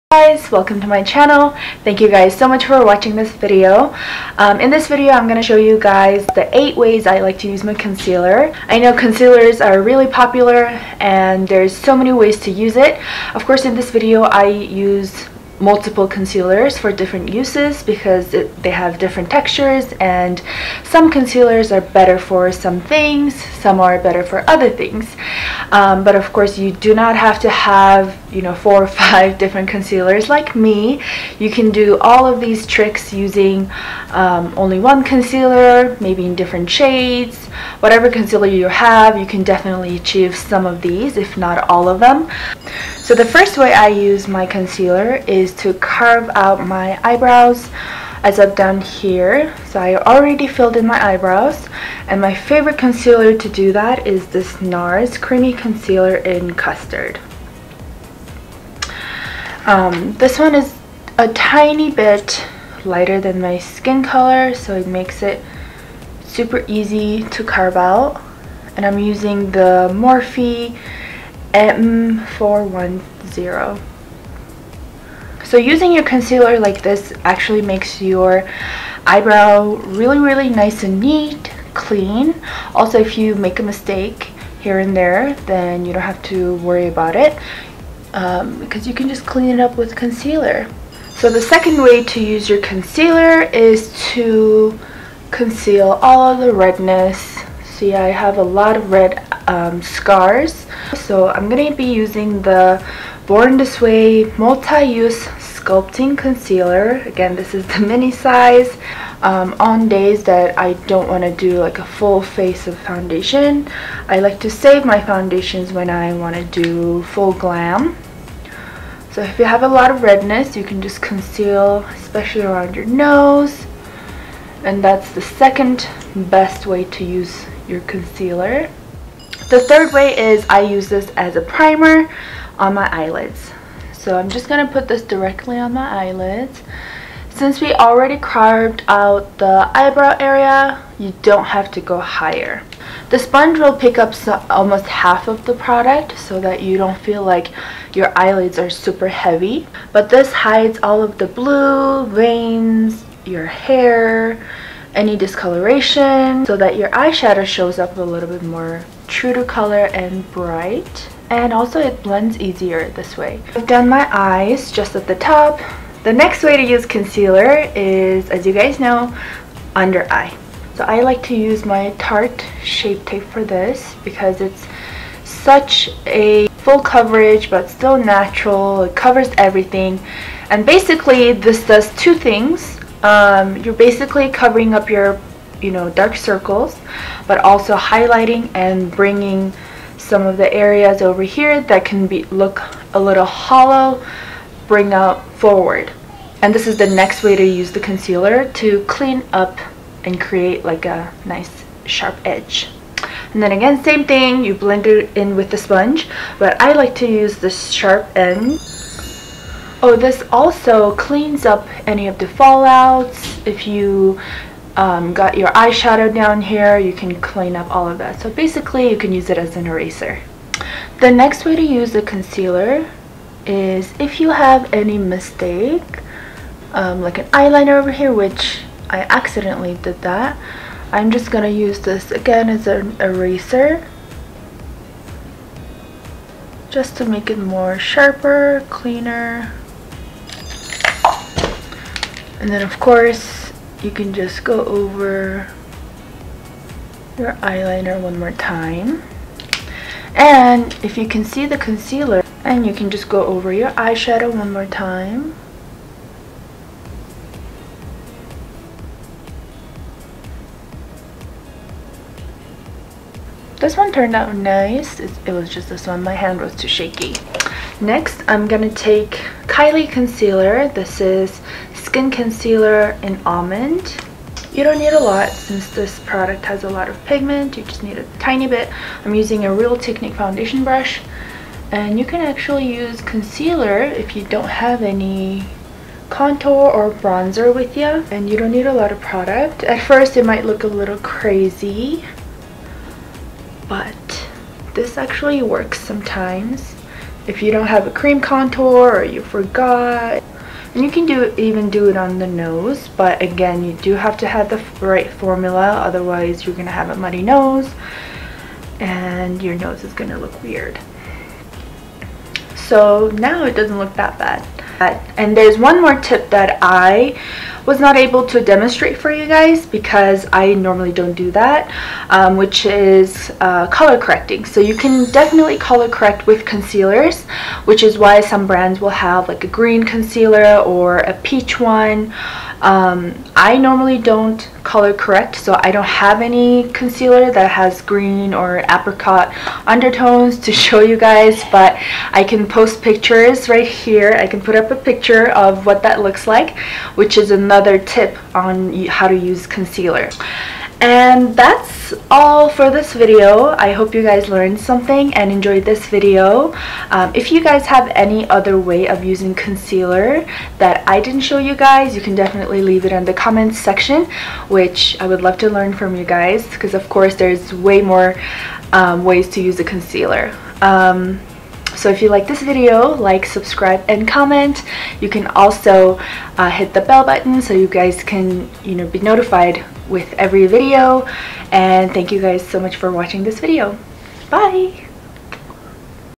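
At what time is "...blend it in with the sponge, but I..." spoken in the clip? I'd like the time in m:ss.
3:24.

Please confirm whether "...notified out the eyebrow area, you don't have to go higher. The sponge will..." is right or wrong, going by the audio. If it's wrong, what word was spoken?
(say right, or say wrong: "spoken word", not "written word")
wrong: "carved", not "notified".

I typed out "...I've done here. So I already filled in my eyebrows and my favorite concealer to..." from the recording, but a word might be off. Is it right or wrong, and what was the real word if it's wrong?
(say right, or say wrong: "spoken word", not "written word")
right.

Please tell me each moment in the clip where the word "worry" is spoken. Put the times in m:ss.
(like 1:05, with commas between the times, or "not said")
1:26.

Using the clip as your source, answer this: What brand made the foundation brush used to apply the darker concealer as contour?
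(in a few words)
Real Technique.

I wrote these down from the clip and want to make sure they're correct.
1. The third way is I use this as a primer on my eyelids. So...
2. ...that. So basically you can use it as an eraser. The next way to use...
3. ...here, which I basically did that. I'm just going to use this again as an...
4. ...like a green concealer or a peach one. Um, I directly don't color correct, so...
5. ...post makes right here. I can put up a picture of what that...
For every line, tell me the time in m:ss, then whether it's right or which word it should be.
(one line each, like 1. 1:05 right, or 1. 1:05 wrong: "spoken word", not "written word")
1. 2:09 right
2. 3:37 right
3. 3:47 wrong: "accidentally", not "basically"
4. 5:29 wrong: "normally", not "directly"
5. 5:42 wrong: "pictures", not "makes".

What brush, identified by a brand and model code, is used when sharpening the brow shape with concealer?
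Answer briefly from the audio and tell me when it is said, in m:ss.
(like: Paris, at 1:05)
Morphe M410, at 1:09.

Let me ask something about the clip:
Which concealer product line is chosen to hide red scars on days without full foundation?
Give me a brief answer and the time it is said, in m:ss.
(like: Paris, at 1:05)
Born This Way Multi-Use Sculpting Concealer, at 1:43.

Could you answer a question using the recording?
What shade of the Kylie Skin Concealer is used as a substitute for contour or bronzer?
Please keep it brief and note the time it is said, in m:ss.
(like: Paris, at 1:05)
Almond, at 4:33.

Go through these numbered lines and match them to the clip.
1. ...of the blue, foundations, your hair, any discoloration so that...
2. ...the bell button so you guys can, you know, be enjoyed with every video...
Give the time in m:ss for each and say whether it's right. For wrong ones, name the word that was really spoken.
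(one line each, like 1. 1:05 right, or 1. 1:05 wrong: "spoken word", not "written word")
1. 2:31 wrong: "veins", not "foundations"
2. 6:16 wrong: "notified", not "enjoyed".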